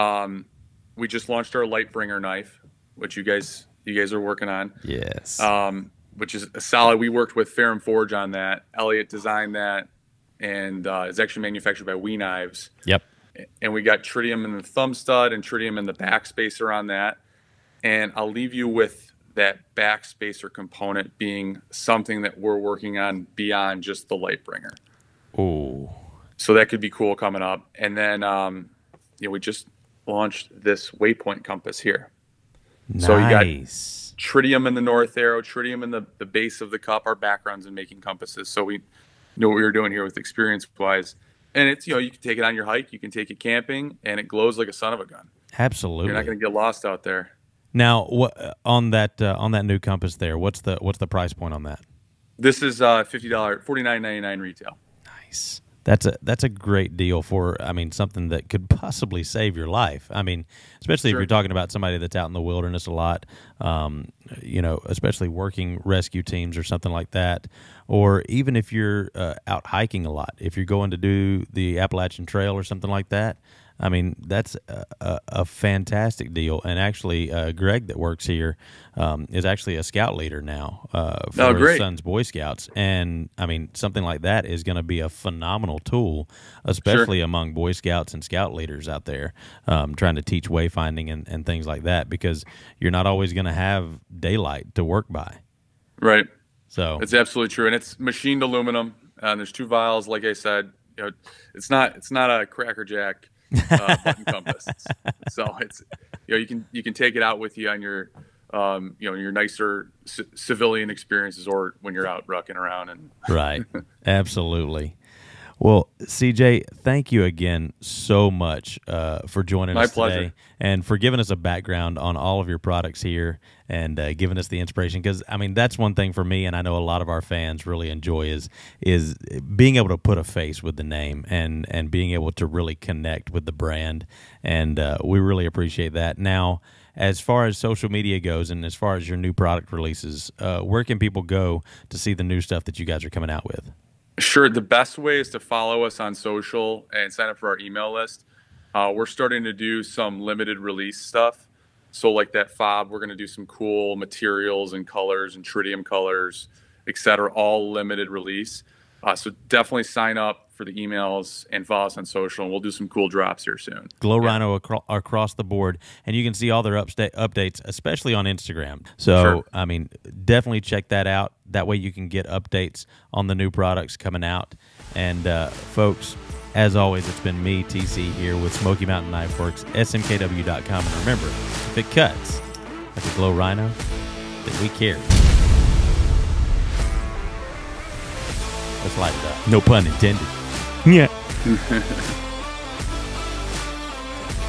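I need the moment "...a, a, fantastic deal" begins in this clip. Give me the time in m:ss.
1:14.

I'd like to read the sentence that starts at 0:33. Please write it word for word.
So you got tritium in the north arrow, tritium in the, the base of the cup.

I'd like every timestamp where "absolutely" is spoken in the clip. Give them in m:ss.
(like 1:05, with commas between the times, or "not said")
0:45, 1:37, 1:54.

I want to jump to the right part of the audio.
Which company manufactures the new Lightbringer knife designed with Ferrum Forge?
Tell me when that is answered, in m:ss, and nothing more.
0:11.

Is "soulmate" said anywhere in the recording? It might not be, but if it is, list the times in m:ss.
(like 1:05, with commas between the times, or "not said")
not said.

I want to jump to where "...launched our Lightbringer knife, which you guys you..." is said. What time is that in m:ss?
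0:01.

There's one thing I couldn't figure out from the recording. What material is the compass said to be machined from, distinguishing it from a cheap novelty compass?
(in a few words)
aluminum.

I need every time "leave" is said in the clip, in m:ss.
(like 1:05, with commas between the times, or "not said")
0:18.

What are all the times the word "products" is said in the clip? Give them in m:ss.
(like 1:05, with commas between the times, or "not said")
2:02, 2:19, 2:53.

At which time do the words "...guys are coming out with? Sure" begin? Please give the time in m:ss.
2:22.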